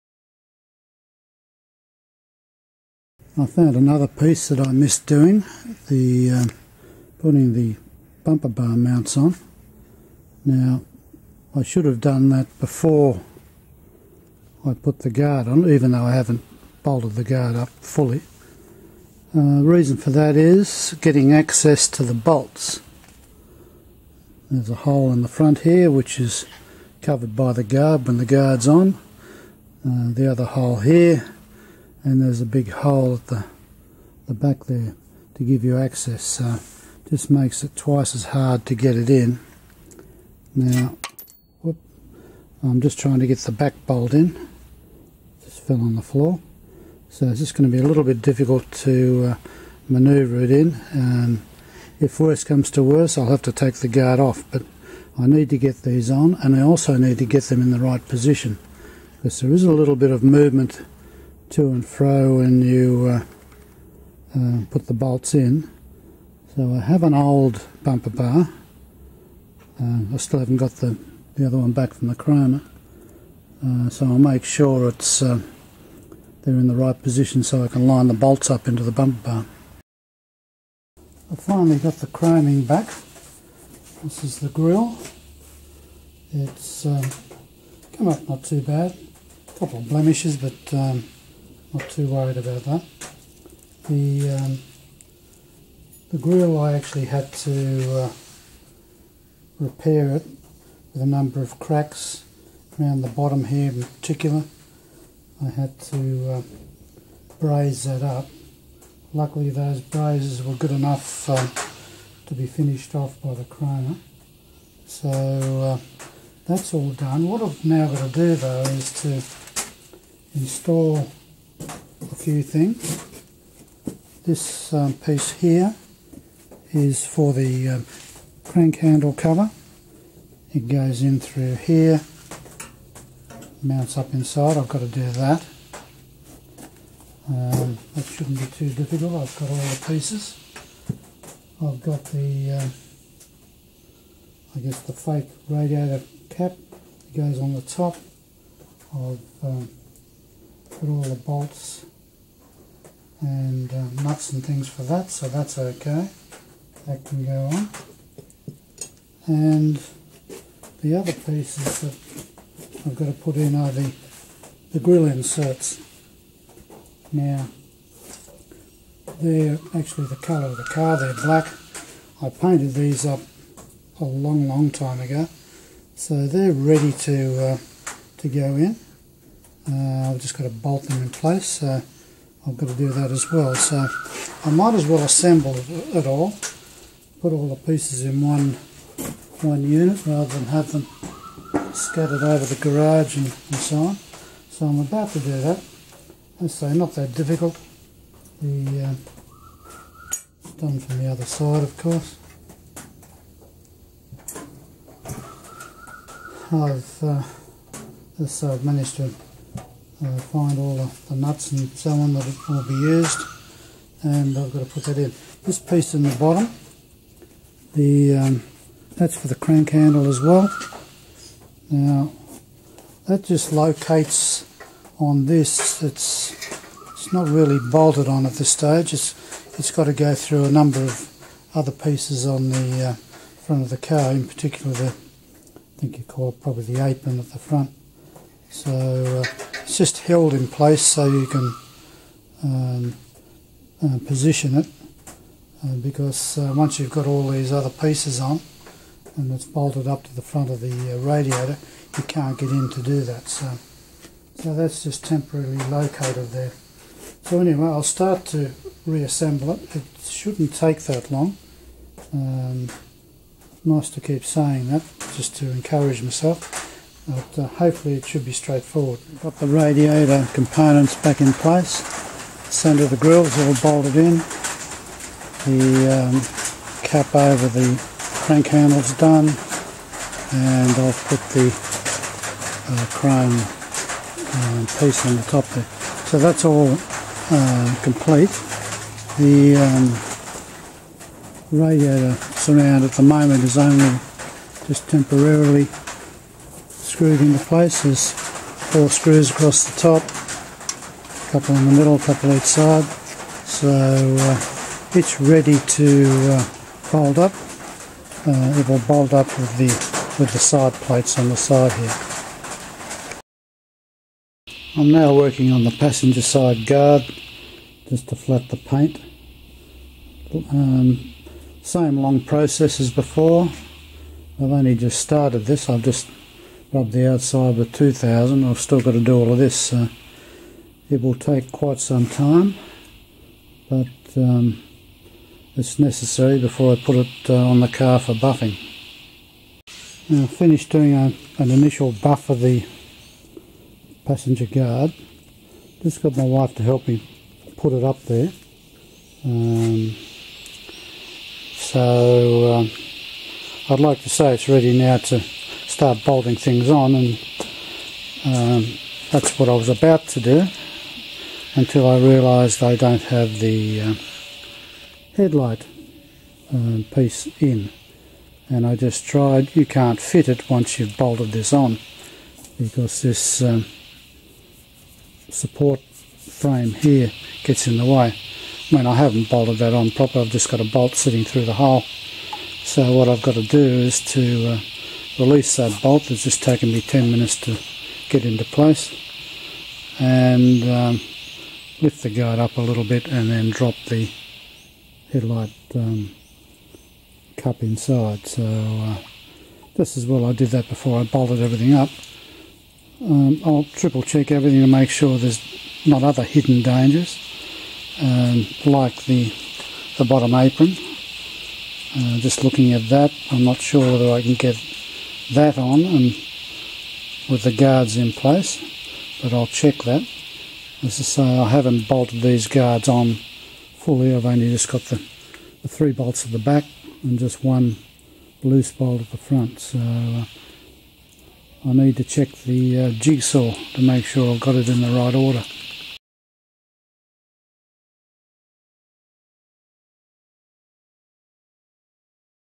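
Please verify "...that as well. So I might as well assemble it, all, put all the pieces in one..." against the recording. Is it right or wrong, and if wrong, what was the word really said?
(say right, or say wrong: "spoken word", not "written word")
right.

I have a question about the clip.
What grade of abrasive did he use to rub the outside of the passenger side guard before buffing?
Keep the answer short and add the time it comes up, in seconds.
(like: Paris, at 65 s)
2000, at 327 s.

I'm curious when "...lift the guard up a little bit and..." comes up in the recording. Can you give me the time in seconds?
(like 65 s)
391 s.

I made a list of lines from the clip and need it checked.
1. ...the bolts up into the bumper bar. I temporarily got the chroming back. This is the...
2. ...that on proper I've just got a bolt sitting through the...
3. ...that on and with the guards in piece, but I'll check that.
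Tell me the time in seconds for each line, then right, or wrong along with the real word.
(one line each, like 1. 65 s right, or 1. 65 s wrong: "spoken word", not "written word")
1. 78 s wrong: "finally", not "temporarily"
2. 379 s right
3. 415 s wrong: "place", not "piece".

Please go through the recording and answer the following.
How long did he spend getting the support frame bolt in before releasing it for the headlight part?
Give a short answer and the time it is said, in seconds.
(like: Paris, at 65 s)
10 minutes, at 386 s.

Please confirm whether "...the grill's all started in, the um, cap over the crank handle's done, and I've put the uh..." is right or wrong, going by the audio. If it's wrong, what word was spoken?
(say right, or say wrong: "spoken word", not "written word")
wrong: "bolted", not "started".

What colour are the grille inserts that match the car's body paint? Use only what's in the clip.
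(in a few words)
Black.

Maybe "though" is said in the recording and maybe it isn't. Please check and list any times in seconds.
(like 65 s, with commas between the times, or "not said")
15 s, 118 s.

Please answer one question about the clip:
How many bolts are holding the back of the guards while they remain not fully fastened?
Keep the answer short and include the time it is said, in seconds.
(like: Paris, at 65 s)
3, at 425 s.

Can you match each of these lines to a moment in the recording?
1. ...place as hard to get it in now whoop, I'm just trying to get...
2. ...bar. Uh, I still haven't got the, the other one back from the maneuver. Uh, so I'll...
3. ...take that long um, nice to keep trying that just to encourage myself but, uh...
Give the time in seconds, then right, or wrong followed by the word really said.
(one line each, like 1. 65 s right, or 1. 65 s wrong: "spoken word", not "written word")
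1. 37 s wrong: "twice", not "place"
2. 68 s wrong: "chromer", not "maneuver"
3. 260 s wrong: "saying", not "trying".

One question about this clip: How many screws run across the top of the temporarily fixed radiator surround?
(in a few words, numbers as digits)
4.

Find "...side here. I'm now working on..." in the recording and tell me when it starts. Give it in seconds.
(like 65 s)
311 s.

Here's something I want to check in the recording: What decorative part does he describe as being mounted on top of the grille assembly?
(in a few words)
Fake radiator cap.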